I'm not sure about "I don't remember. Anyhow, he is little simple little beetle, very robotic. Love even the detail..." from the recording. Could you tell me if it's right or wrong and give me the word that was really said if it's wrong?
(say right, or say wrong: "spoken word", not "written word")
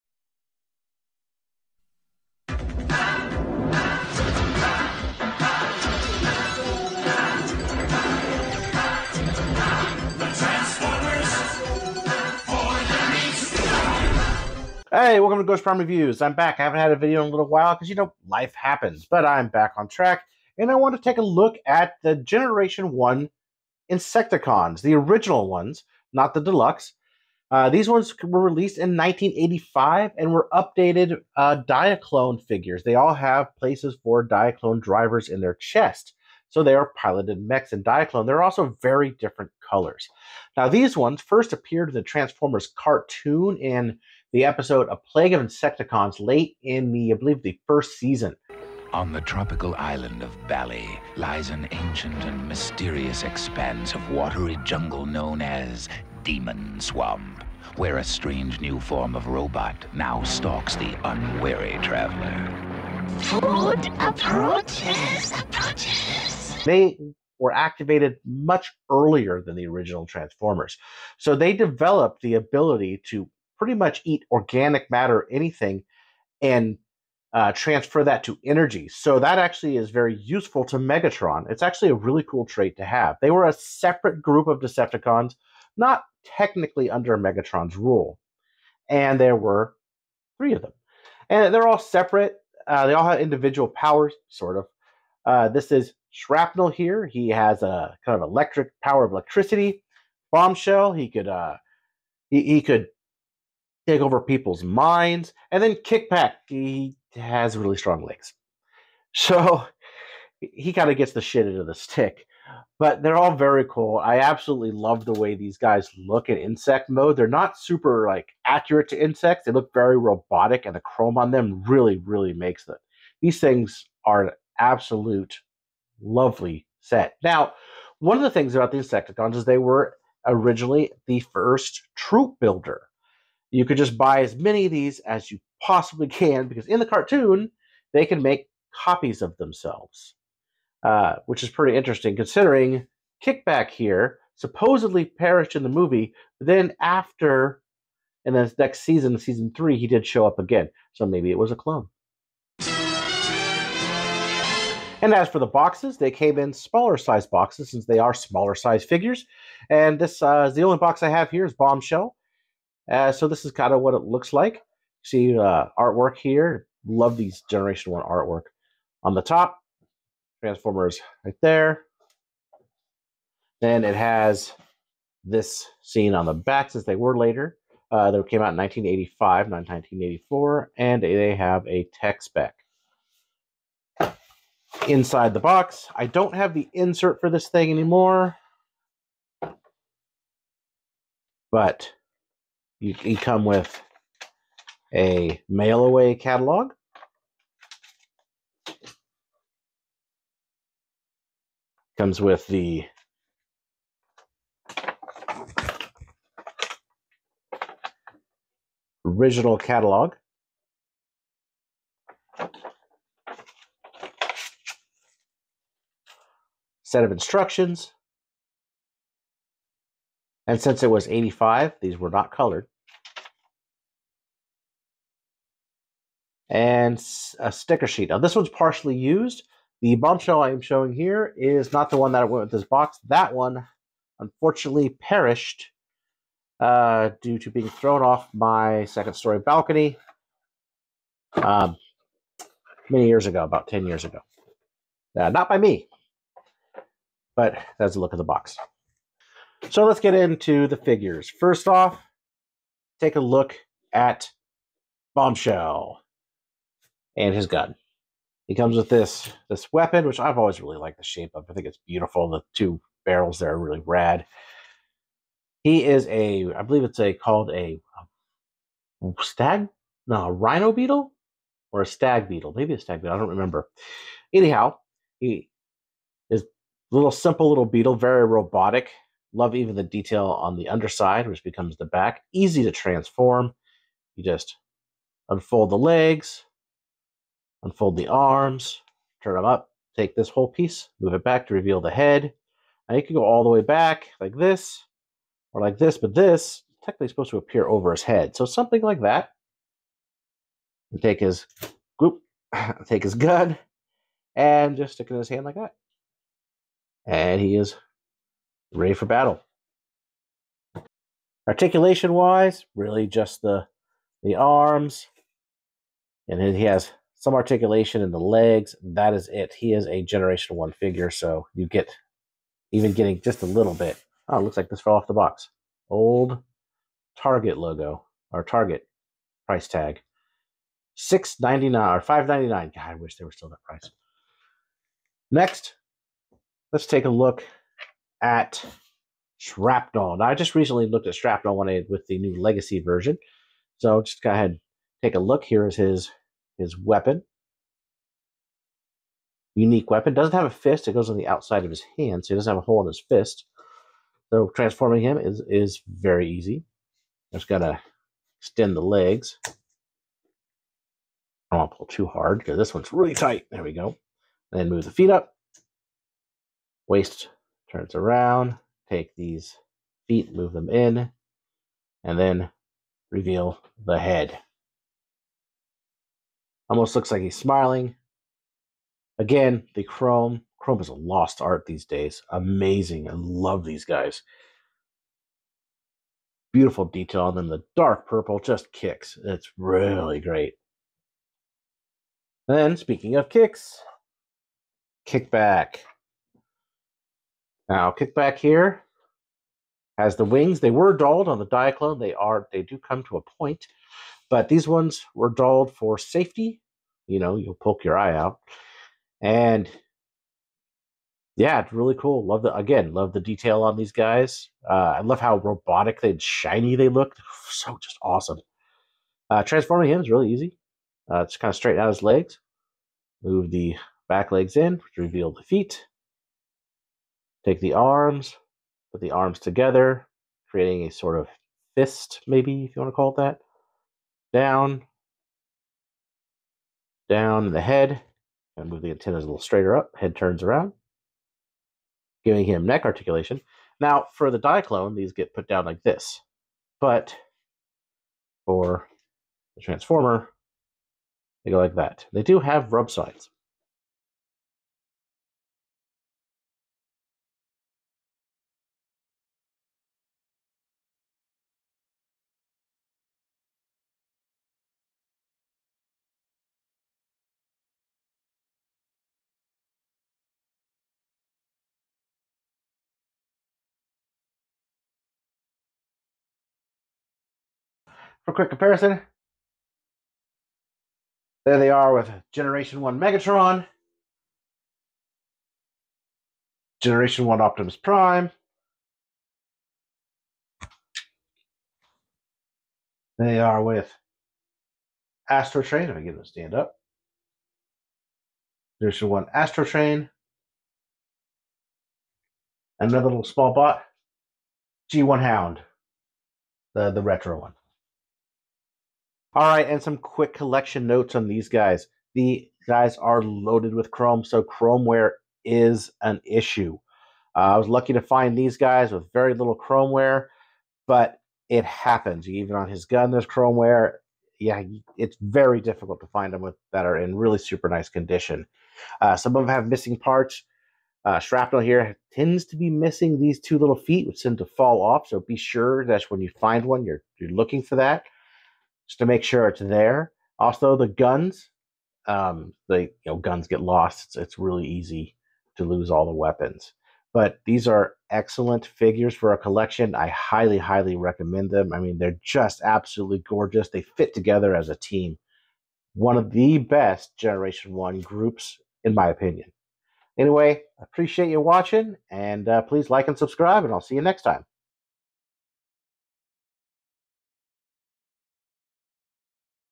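right.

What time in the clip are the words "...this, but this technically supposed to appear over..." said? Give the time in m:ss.
4:55.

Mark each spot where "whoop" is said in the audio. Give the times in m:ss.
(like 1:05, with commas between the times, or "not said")
5:01.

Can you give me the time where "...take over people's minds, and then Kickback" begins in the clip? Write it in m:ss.
1:43.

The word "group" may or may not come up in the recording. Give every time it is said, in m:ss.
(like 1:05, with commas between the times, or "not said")
1:24, 9:18.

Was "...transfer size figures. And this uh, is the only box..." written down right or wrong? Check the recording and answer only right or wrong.
wrong.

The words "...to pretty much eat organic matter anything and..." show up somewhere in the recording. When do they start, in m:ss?
1:13.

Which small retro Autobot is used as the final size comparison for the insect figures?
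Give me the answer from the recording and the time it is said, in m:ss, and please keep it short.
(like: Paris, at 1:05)
Hound, at 8:25.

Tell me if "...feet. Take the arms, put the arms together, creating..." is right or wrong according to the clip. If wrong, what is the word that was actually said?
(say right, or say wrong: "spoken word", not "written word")
right.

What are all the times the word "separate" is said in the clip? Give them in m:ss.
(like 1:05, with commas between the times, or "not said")
1:23, 1:31.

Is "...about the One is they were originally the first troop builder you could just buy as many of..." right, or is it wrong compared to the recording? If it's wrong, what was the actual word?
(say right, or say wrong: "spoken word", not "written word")
wrong: "Insecticons", not "One".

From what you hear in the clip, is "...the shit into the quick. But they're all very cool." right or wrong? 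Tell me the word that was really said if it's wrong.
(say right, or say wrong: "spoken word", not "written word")
wrong: "stick", not "quick".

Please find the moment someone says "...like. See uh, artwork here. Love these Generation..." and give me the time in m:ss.
2:44.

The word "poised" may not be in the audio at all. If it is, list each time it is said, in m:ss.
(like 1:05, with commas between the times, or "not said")
not said.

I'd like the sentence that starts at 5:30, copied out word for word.
Six ninety nine or five ninety nine.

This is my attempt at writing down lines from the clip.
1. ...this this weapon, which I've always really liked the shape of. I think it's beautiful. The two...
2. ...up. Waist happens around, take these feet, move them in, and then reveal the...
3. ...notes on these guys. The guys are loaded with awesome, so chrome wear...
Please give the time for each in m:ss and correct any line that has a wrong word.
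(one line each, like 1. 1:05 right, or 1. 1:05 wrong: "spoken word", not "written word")
1. 4:18 right
2. 6:05 wrong: "turns", not "happens"
3. 8:30 wrong: "chrome", not "awesome".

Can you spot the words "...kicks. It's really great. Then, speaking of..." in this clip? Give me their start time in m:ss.
6:28.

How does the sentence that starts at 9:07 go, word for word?
But these are excellent figures for a collection.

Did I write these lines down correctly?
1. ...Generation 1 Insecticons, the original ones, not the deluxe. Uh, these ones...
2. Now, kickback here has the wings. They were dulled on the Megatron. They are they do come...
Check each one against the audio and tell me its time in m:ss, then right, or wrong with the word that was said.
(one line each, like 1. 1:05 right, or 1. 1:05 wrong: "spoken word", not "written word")
1. 0:22 right
2. 6:37 wrong: "Diaclone", not "Megatron".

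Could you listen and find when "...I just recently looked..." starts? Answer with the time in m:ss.
5:40.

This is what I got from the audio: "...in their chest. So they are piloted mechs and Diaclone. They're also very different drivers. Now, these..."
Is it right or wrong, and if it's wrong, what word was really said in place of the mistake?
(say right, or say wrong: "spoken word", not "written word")
wrong: "colors", not "drivers".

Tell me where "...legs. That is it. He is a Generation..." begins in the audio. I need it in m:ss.
5:18.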